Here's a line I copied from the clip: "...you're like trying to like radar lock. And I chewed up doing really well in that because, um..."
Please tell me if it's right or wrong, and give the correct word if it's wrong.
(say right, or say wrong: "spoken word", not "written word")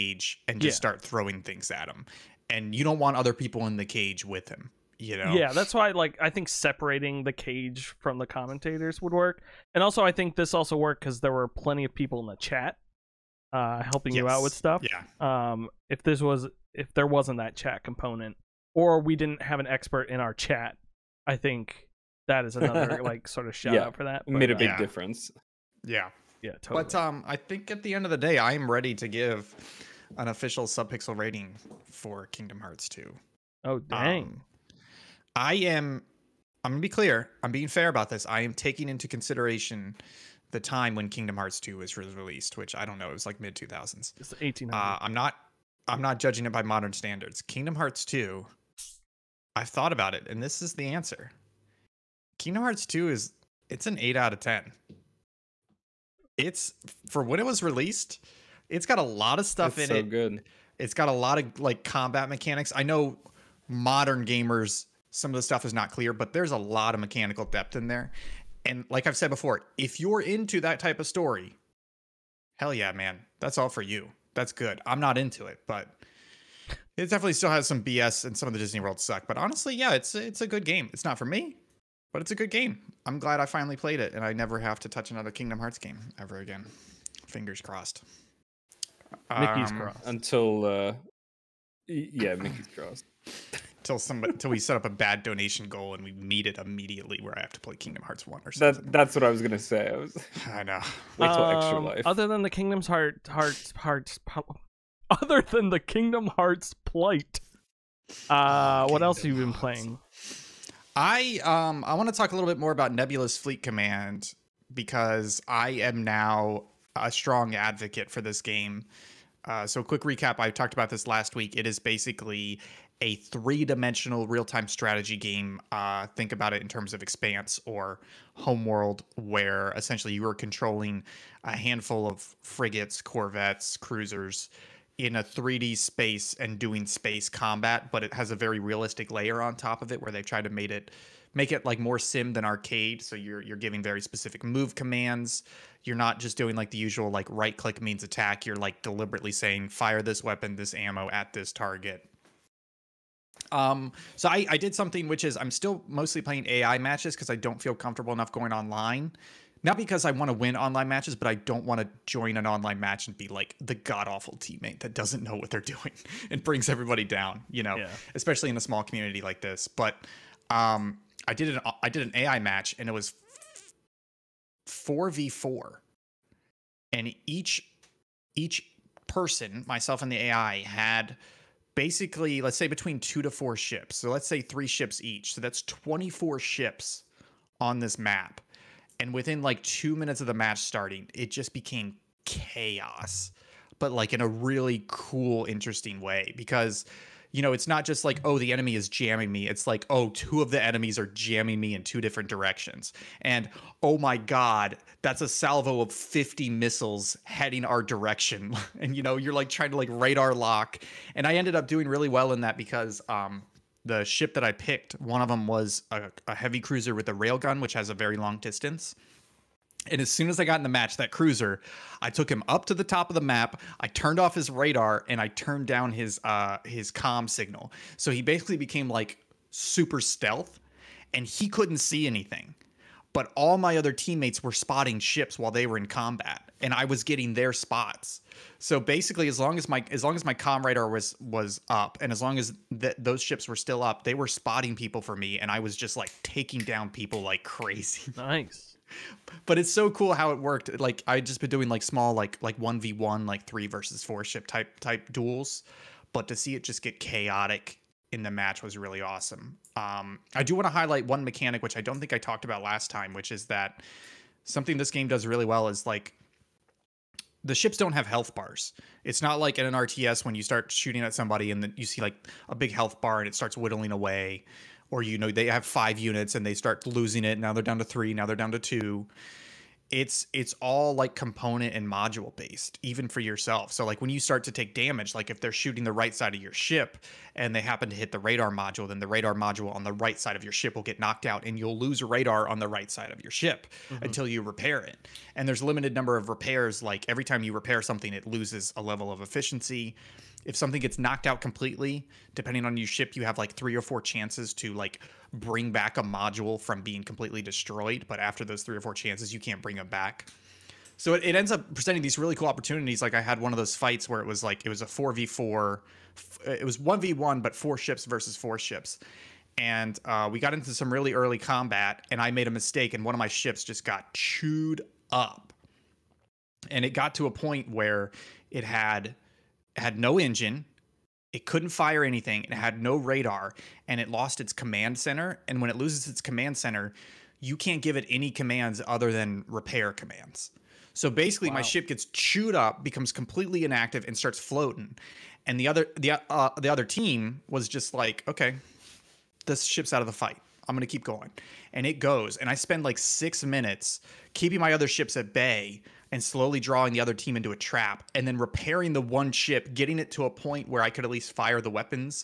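wrong: "ended", not "chewed".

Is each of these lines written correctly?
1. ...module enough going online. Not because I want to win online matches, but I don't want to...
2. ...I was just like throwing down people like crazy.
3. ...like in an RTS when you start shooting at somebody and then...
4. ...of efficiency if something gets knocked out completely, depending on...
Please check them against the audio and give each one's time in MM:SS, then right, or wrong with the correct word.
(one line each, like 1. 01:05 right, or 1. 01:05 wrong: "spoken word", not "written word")
1. 02:37 wrong: "comfortable", not "module"
2. 04:05 wrong: "taking", not "throwing"
3. 04:29 right
4. 04:59 right.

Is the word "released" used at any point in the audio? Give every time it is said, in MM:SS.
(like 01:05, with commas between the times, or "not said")
00:41, 00:57.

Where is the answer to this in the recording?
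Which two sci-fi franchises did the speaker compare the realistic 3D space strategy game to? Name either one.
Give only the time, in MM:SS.
02:07.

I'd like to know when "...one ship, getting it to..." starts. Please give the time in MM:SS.
05:59.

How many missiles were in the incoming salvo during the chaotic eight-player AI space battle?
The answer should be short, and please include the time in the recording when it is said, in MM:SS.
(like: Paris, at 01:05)
50, at 03:25.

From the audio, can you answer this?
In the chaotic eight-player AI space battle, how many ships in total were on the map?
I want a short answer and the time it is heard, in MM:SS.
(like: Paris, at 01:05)
24, at 03:05.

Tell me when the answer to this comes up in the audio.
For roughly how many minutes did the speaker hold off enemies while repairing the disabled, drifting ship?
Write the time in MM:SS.
05:52.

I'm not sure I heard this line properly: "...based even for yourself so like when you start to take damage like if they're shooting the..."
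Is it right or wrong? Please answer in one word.
right.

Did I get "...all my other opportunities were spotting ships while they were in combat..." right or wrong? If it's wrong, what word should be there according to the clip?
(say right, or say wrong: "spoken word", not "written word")
wrong: "teammates", not "opportunities".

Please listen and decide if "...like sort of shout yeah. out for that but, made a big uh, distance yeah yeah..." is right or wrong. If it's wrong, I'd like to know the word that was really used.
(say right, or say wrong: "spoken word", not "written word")
wrong: "difference", not "distance".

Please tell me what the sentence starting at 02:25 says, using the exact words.
You're not just doing like the usual like right click means attack.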